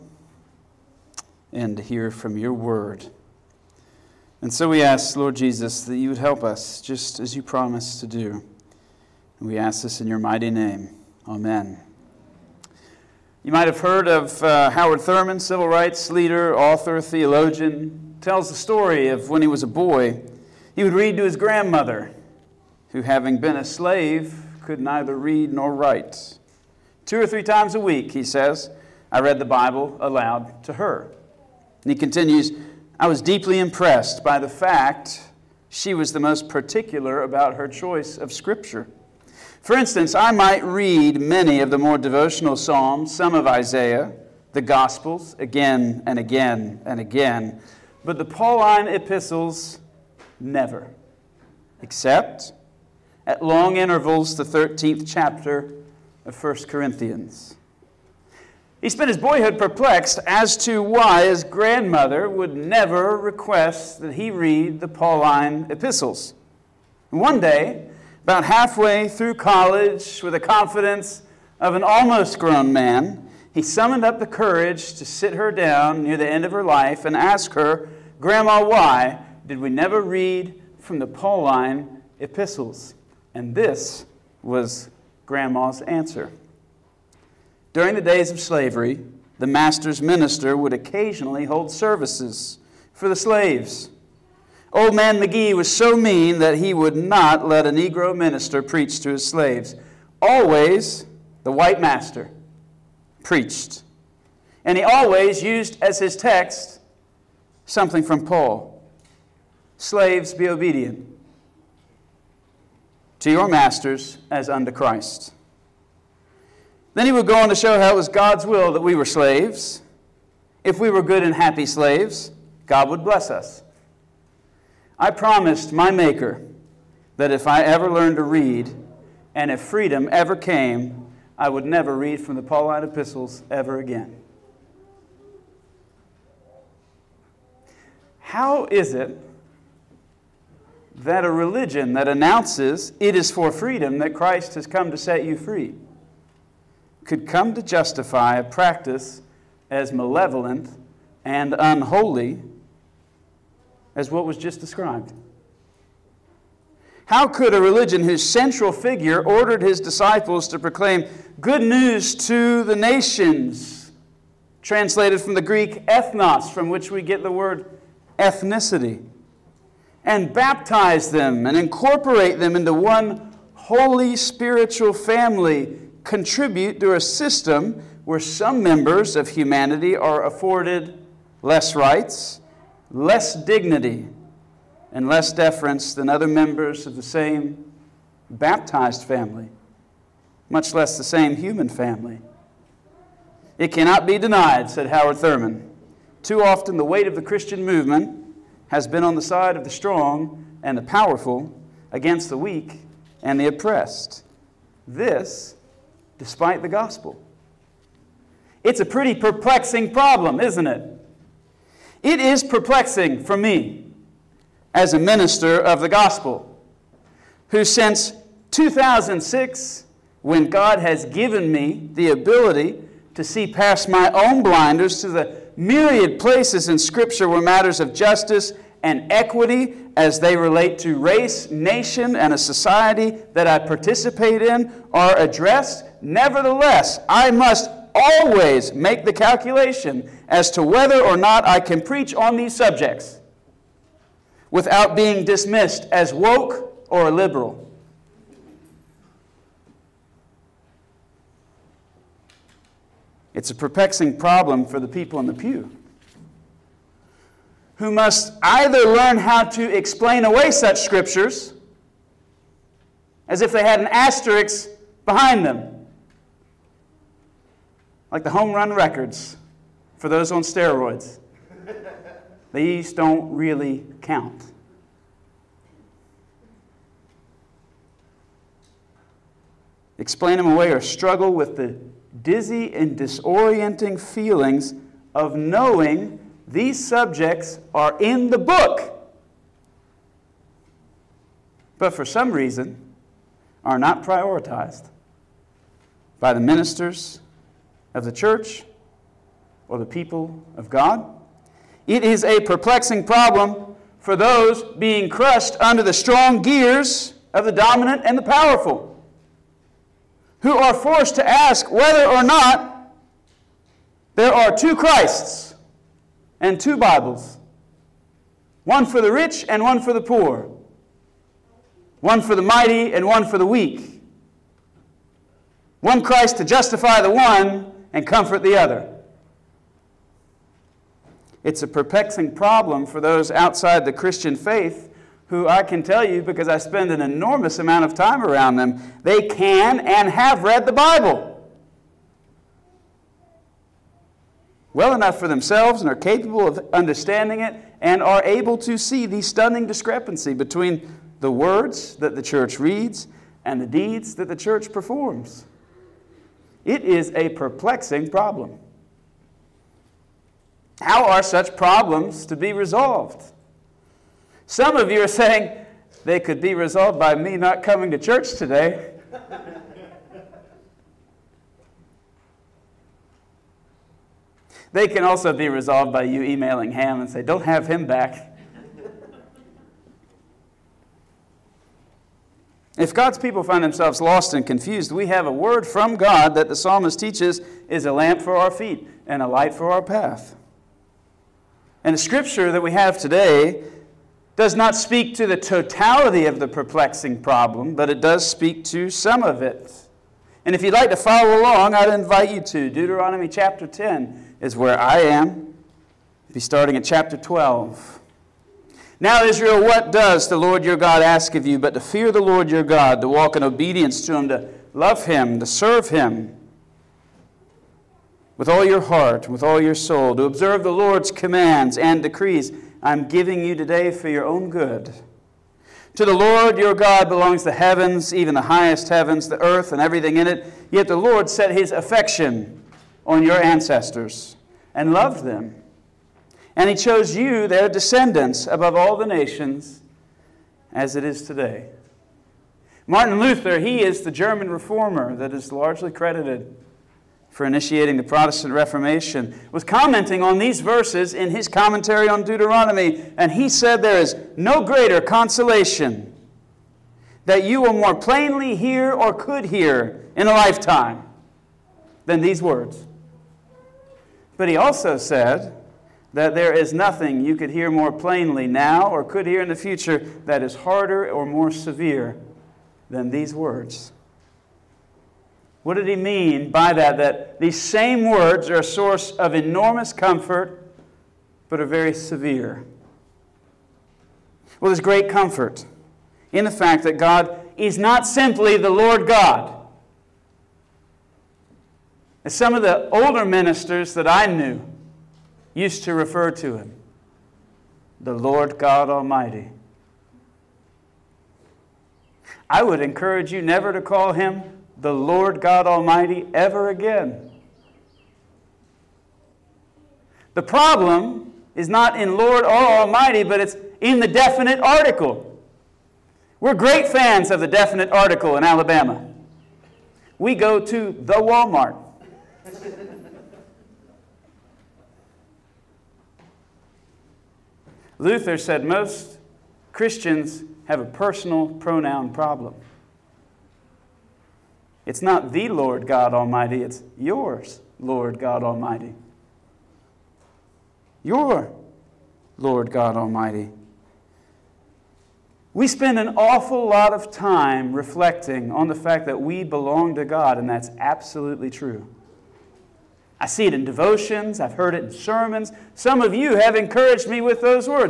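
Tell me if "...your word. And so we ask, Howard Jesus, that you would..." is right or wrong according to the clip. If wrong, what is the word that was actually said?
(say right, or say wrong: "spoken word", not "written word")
wrong: "Lord", not "Howard".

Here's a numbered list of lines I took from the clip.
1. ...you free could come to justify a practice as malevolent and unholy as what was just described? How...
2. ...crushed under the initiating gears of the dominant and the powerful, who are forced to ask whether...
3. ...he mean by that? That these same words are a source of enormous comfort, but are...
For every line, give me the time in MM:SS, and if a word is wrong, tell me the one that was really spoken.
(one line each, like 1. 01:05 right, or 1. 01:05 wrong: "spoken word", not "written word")
1. 02:25 right
2. 05:05 wrong: "strong", not "initiating"
3. 07:55 right.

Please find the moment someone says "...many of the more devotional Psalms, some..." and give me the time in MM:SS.
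00:41.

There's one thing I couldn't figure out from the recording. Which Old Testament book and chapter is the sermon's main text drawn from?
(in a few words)
Deuteronomy 10.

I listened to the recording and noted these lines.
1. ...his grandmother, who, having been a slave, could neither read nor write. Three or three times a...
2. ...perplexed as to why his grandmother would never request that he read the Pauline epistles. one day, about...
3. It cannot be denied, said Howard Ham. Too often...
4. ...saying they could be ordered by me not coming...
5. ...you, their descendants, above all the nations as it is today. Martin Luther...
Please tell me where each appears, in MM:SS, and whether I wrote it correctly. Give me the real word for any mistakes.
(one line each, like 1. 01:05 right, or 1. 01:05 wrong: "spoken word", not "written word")
1. 00:21 wrong: "Two", not "Three"
2. 00:59 right
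3. 03:13 wrong: "Thurman", not "Ham"
4. 06:05 wrong: "resolved", not "ordered"
5. 07:17 right.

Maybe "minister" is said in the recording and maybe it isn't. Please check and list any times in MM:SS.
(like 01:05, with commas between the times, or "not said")
01:29, 01:38, 03:34, 04:56, 08:13.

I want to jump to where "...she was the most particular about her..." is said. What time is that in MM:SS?
00:35.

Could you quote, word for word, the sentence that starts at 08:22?
I would encourage you never to call him the Lord God Almighty ever again.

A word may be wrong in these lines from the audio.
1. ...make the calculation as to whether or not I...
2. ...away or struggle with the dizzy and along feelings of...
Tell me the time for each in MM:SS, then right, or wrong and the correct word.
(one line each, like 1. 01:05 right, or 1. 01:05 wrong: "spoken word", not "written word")
1. 03:58 right
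2. 04:40 wrong: "disorienting", not "along".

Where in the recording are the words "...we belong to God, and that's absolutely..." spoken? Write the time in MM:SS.
09:09.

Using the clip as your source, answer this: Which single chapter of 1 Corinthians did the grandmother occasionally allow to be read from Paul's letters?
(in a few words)
13th chapter.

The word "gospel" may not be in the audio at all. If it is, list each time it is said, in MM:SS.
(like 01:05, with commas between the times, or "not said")
00:44, 03:26, 03:35.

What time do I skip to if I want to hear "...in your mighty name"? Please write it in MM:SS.
00:09.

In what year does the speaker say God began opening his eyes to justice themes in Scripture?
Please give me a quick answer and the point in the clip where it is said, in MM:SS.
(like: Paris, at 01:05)
2006, at 03:38.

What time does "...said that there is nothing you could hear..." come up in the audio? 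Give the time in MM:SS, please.
07:44.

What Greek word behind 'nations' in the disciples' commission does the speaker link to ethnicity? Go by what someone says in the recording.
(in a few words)
ethnos.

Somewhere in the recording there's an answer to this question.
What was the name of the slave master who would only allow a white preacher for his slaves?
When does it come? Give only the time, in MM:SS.
01:34.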